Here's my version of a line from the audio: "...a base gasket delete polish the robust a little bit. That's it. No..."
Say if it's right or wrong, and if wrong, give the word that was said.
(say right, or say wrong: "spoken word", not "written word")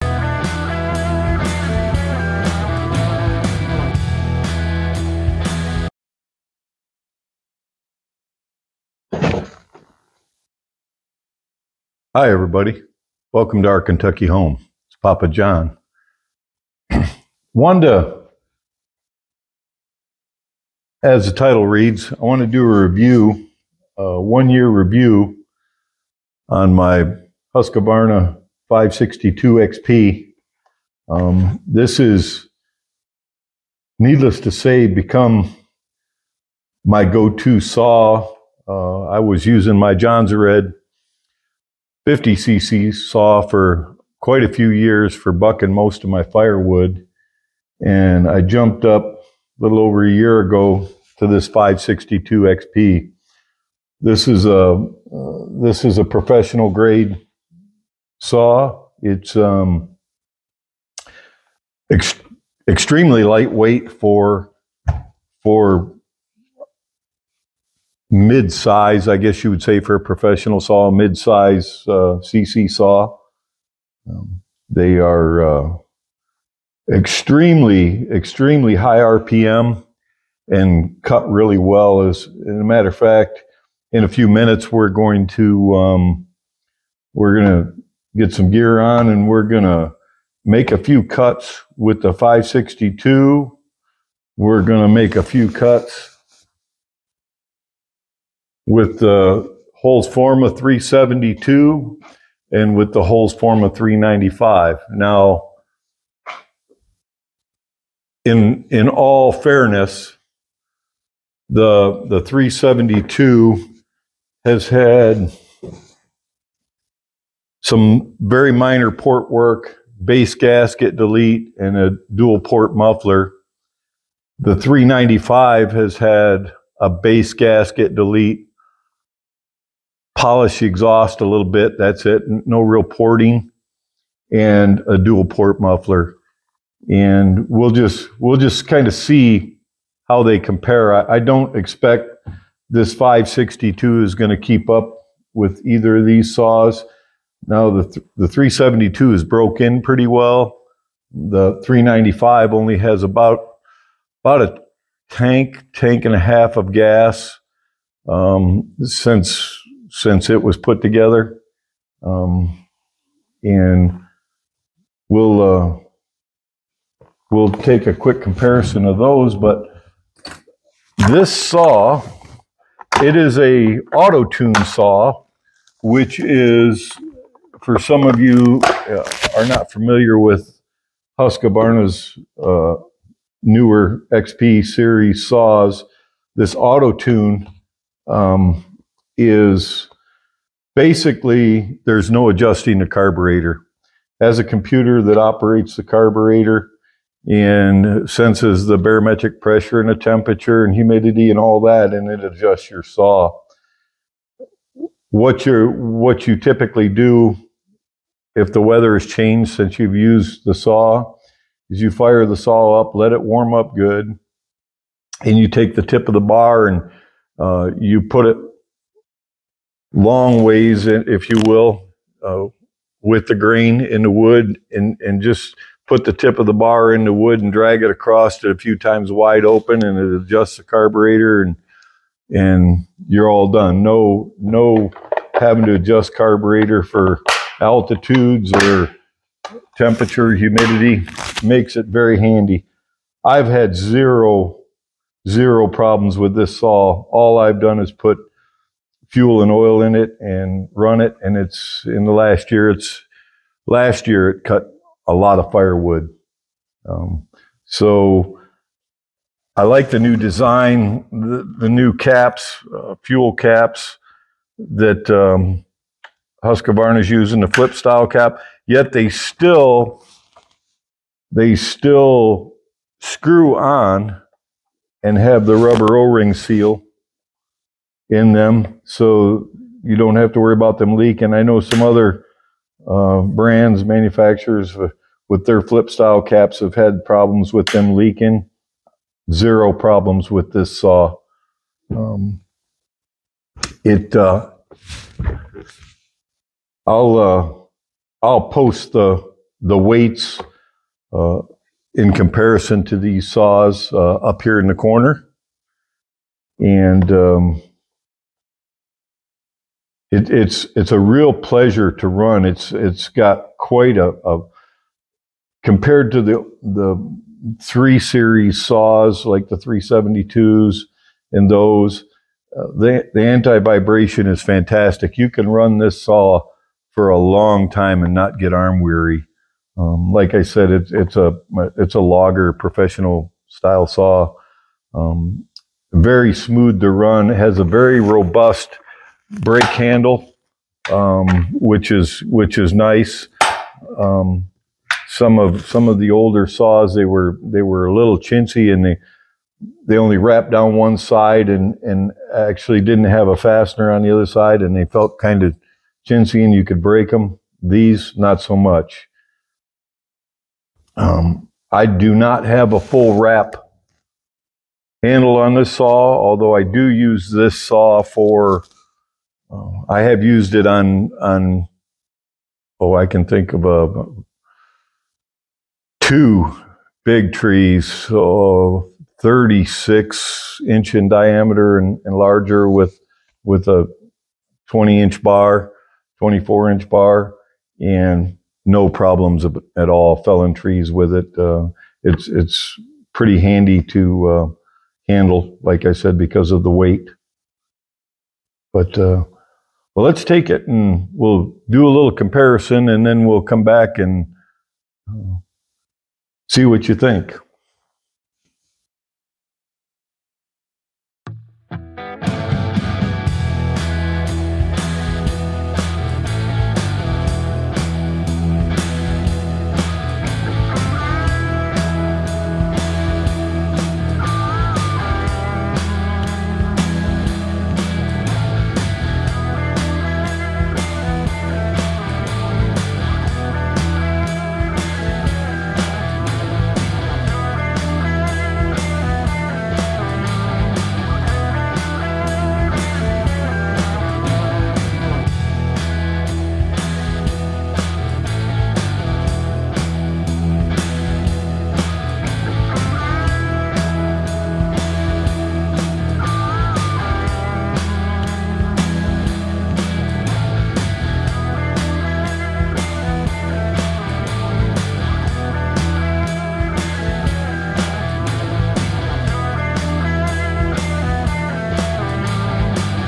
wrong: "exhaust", not "robust".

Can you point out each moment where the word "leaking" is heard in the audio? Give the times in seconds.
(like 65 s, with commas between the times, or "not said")
280 s, 287 s.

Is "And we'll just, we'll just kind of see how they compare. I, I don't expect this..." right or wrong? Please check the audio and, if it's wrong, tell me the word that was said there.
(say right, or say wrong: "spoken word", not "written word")
right.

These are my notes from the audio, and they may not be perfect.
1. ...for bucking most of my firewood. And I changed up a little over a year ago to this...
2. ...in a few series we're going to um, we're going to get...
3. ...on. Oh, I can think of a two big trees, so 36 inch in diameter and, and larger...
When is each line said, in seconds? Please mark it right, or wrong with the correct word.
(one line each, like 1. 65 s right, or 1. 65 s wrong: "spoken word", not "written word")
1. 45 s wrong: "jumped", not "changed"
2. 83 s wrong: "minutes", not "series"
3. 371 s right.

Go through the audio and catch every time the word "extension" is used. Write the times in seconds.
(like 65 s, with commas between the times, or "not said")
not said.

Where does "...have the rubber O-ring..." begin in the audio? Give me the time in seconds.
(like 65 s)
275 s.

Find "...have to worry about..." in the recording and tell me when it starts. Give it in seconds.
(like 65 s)
280 s.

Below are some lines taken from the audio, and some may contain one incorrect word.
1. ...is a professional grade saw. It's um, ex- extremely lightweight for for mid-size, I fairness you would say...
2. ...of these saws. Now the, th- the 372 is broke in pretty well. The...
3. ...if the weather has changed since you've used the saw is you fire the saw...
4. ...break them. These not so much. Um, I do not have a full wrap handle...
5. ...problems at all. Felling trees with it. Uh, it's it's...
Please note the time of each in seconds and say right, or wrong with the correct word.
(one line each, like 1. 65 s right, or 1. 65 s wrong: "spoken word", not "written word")
1. 55 s wrong: "guess", not "fairness"
2. 145 s right
3. 208 s right
4. 356 s right
5. 388 s right.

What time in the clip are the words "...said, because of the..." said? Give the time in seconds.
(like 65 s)
395 s.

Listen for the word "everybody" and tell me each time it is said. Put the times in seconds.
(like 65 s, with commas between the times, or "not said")
12 s.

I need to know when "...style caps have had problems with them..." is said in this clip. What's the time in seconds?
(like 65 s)
285 s.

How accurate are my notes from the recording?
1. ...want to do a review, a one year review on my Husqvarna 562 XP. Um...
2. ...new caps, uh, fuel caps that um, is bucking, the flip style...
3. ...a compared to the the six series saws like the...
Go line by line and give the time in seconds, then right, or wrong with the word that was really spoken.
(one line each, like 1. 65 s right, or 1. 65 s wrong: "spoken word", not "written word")
1. 22 s right
2. 261 s wrong: "using", not "bucking"
3. 314 s wrong: "three", not "six".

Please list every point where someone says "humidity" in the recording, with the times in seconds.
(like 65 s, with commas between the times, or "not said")
200 s, 240 s.